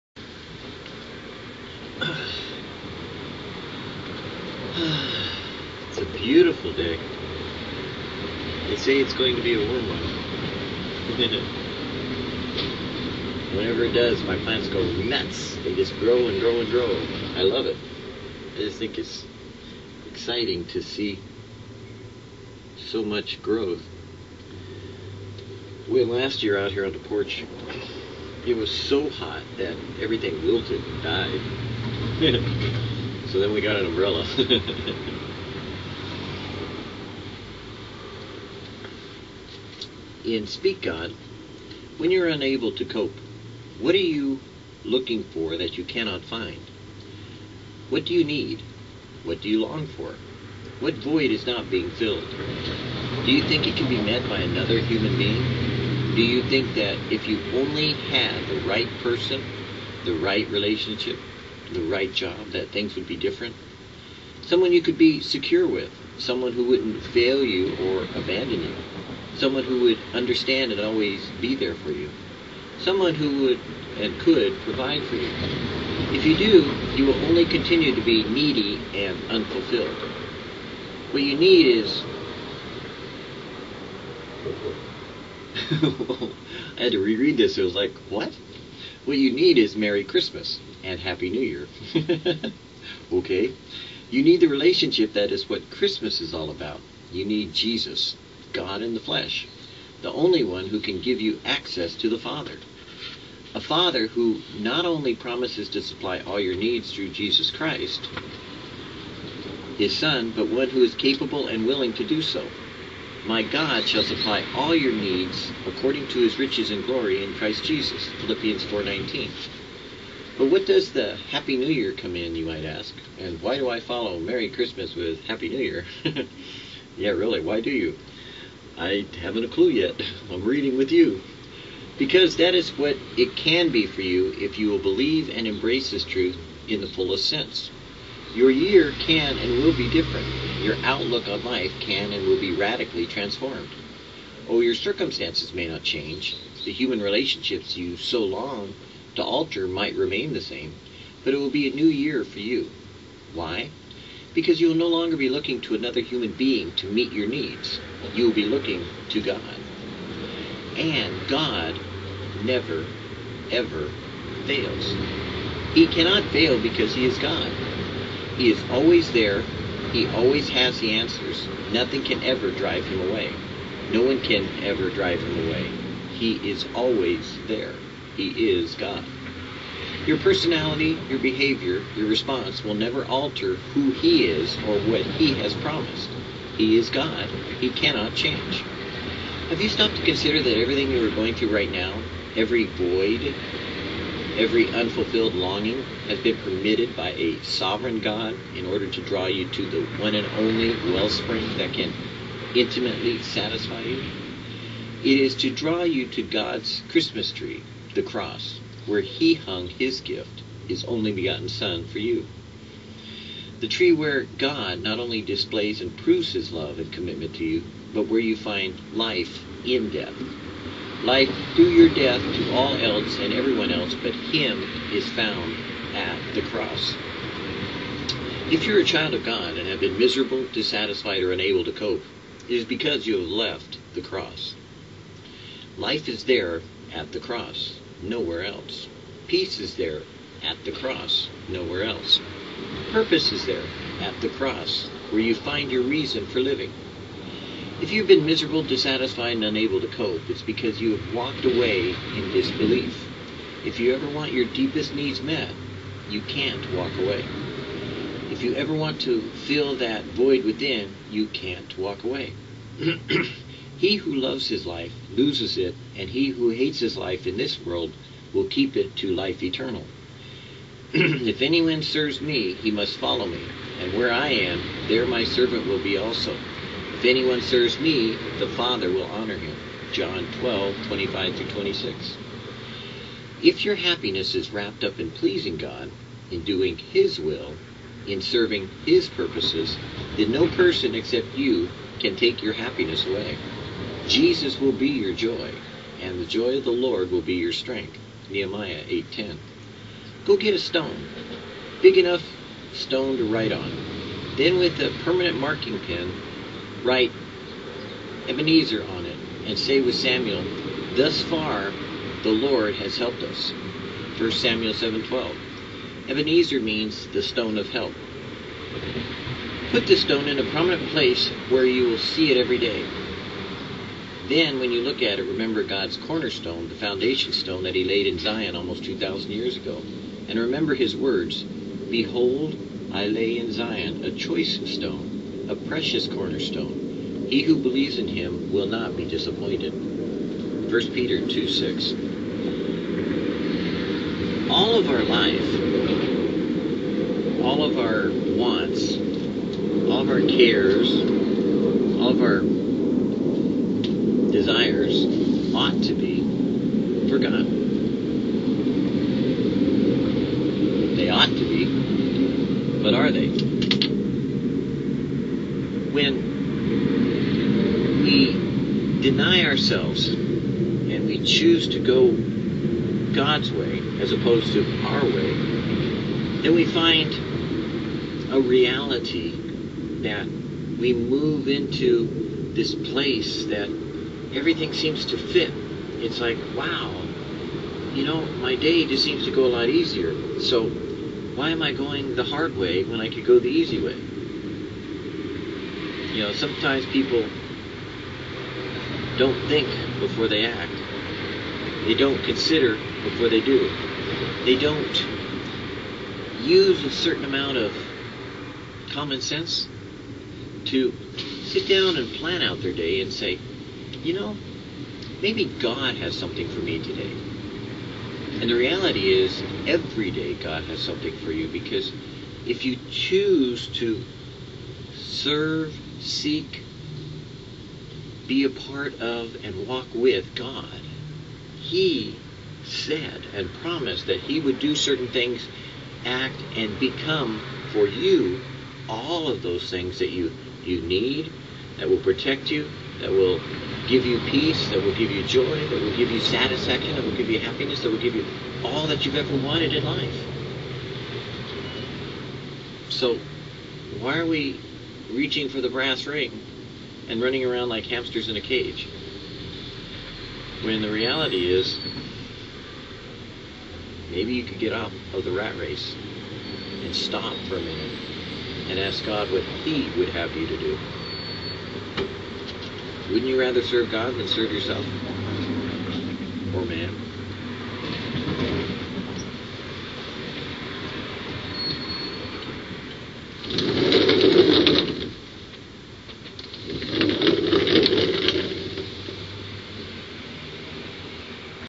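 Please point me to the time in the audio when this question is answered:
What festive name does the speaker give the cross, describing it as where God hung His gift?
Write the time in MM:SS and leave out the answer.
03:26.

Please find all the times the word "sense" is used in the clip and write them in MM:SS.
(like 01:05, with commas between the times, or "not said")
02:17, 06:49.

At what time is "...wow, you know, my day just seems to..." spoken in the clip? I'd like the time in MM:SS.
06:26.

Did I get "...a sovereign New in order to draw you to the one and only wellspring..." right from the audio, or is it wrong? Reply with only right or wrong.
wrong.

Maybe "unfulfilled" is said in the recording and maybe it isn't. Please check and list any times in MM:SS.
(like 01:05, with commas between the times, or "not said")
01:19, 03:14.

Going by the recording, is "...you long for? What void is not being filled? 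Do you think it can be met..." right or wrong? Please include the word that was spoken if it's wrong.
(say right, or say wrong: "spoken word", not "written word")
right.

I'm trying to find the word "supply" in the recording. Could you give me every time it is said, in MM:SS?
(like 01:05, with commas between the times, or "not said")
01:45, 01:54.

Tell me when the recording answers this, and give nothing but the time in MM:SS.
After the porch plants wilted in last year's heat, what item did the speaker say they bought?
00:33.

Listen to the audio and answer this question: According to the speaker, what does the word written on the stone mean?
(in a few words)
The stone of help.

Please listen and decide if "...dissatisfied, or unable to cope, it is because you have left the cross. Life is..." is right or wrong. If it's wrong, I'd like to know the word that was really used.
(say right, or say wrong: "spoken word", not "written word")
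right.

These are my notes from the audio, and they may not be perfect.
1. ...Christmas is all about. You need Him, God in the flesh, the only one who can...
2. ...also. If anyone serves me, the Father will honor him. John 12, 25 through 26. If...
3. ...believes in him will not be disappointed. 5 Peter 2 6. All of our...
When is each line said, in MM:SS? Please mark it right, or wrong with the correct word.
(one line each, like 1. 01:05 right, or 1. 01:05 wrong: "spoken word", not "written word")
1. 01:35 wrong: "Jesus", not "Him"
2. 04:35 right
3. 05:37 wrong: "1", not "5".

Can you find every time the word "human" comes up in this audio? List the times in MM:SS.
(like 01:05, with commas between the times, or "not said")
00:54, 02:26, 02:35.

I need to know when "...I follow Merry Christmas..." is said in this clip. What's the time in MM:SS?
02:03.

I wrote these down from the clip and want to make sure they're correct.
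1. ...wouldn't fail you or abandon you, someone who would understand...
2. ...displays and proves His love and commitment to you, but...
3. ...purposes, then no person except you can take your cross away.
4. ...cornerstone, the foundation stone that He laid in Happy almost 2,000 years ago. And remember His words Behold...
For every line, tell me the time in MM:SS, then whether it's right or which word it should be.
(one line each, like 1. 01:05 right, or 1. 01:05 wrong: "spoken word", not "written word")
1. 01:06 right
2. 03:35 right
3. 04:49 wrong: "happiness", not "cross"
4. 05:25 wrong: "Zion", not "Happy".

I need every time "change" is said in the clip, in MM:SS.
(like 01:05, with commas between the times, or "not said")
02:25, 03:08.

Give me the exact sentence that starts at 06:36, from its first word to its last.
You know, sometimes people don't think before they act.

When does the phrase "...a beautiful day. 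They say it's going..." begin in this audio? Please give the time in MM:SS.
00:05.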